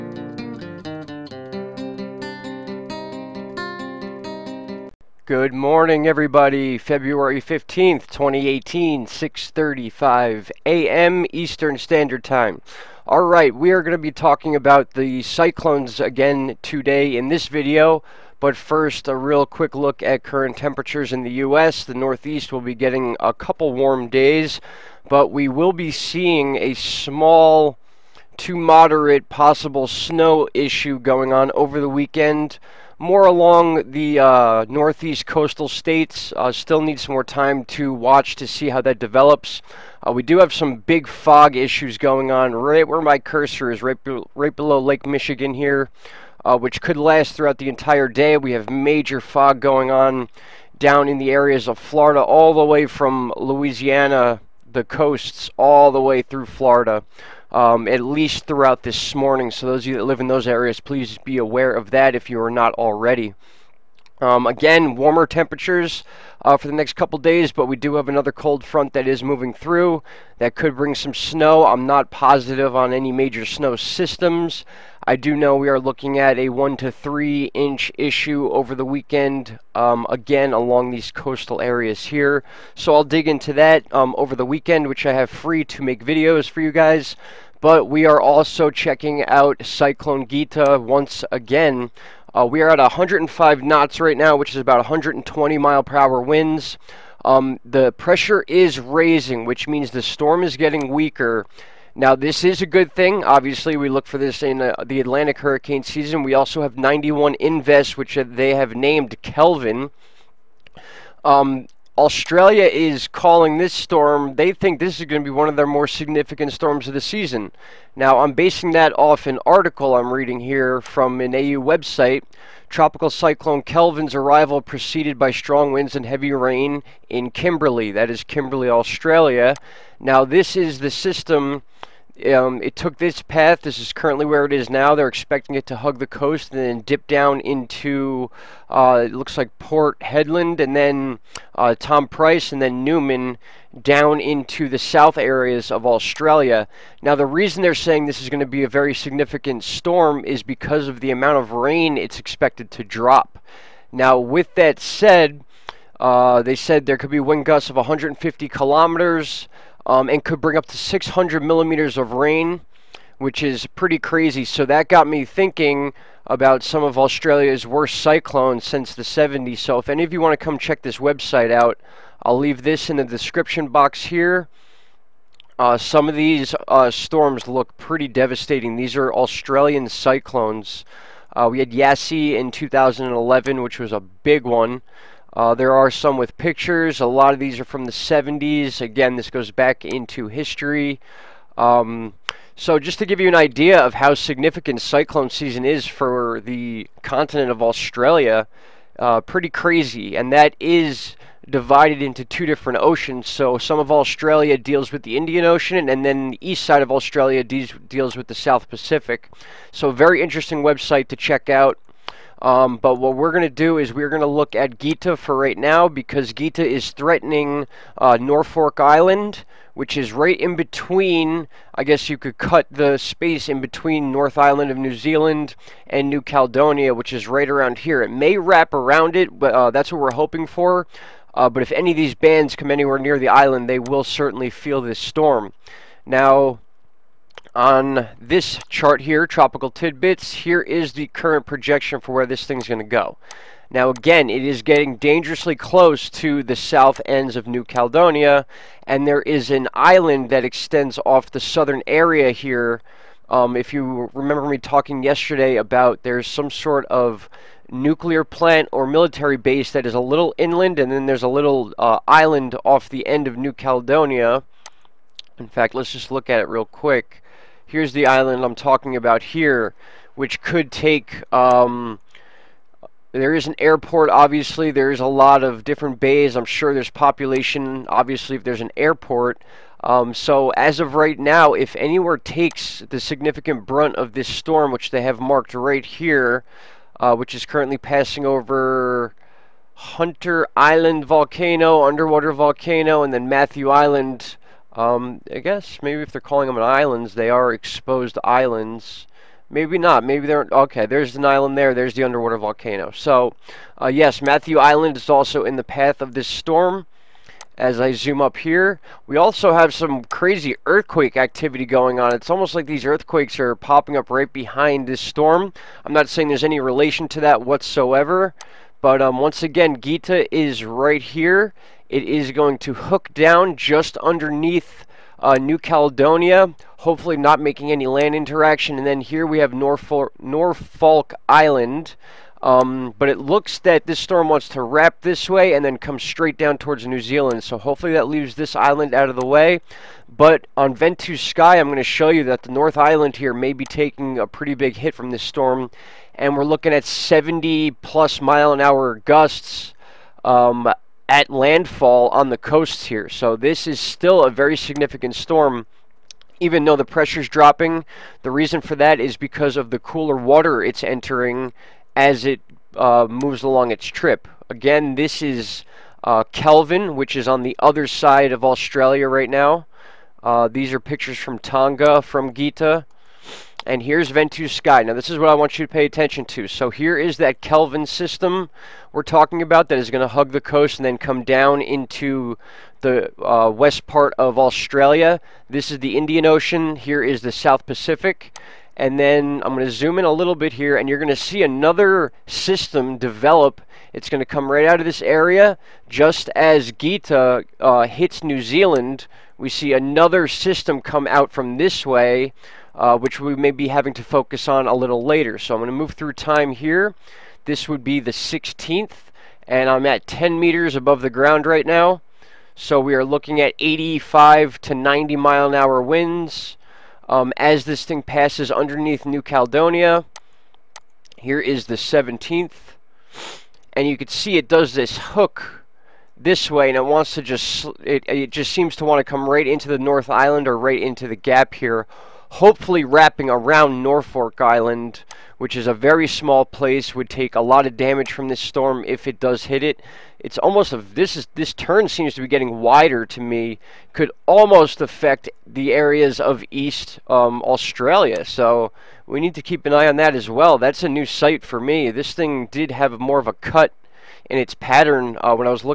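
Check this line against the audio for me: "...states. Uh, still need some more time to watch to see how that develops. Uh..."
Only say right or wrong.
right.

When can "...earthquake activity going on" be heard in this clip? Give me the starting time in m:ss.
5:10.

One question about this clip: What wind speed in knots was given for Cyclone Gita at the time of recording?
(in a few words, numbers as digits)
105 knots.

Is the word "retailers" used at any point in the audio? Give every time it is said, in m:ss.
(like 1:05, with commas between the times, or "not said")
not said.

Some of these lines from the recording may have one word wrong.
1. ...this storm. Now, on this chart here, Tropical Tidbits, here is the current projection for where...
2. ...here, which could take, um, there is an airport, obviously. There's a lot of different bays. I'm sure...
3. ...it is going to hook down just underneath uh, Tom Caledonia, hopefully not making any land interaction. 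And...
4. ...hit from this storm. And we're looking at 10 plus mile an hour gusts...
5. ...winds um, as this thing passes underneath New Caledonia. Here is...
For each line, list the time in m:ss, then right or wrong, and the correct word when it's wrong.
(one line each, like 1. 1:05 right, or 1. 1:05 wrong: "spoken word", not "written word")
1. 3:54 right
2. 4:29 right
3. 5:21 wrong: "New", not "Tom"
4. 5:44 wrong: "70", not "10"
5. 6:55 right.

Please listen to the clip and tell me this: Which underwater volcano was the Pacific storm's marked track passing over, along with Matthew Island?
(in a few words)
Hunter Island volcano.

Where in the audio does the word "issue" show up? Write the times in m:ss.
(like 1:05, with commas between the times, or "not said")
0:30, 0:41, 1:17.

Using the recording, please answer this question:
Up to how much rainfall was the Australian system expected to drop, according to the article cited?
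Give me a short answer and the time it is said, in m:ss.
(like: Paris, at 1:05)
600 millimeters, at 2:40.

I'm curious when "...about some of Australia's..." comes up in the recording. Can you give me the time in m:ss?
2:46.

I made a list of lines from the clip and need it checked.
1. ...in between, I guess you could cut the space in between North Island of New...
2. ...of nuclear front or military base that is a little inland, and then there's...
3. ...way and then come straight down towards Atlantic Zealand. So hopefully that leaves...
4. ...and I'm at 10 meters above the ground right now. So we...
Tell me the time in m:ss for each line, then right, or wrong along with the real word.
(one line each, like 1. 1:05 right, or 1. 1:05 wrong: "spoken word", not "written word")
1. 3:40 right
2. 4:16 wrong: "plant", not "front"
3. 5:35 wrong: "New", not "Atlantic"
4. 6:49 right.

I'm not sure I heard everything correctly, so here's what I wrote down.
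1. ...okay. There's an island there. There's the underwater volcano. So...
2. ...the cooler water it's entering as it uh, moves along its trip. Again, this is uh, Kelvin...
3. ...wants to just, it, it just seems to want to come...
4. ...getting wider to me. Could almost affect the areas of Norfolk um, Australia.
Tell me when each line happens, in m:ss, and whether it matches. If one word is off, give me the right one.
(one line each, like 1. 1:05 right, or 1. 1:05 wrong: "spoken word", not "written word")
1. 5:00 right
2. 5:59 right
3. 7:06 right
4. 7:22 wrong: "East", not "Norfolk".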